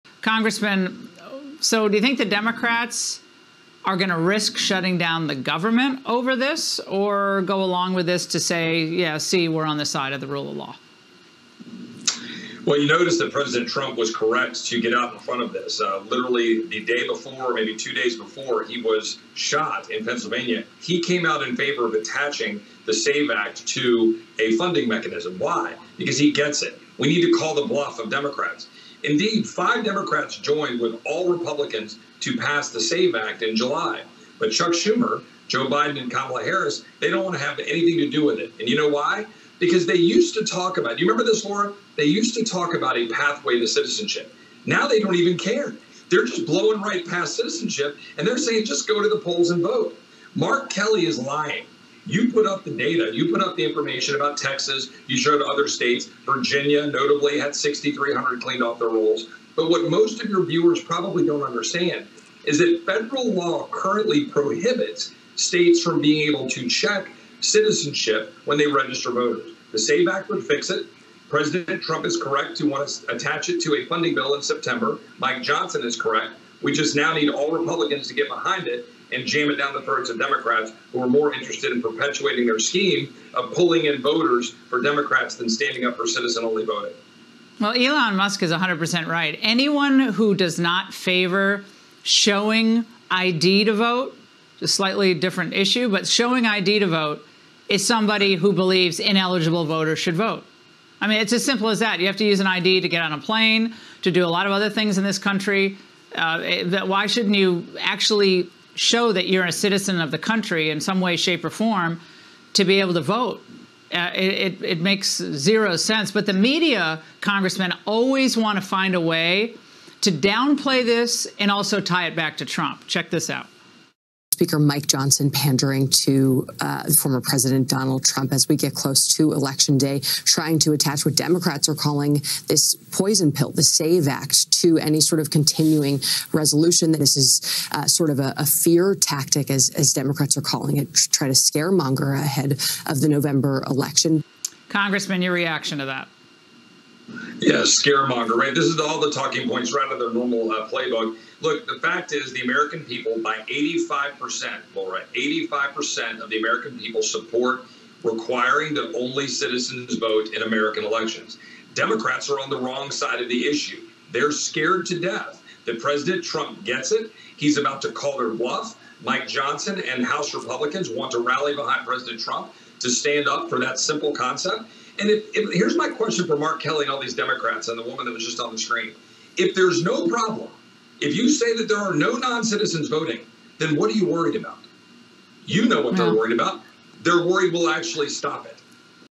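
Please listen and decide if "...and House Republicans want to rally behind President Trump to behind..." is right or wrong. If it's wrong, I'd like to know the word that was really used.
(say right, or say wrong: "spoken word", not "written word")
wrong: "stand", not "behind".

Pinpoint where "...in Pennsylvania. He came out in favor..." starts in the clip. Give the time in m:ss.
0:19.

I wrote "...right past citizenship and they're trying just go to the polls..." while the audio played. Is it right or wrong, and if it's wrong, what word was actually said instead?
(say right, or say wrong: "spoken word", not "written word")
wrong: "saying", not "trying".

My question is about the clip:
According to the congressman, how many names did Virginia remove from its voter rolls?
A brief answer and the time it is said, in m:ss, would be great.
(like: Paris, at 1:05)
6,300, at 0:57.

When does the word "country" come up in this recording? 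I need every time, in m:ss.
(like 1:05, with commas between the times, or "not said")
1:45, 1:50.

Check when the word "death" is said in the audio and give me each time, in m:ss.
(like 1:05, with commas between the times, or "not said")
2:44.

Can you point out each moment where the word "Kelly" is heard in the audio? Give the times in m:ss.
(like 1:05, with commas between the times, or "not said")
0:50, 2:56.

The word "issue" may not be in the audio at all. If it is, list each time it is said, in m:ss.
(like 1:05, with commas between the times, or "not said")
1:35, 2:43.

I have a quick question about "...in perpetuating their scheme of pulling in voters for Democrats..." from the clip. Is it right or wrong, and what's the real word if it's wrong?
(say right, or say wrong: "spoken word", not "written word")
right.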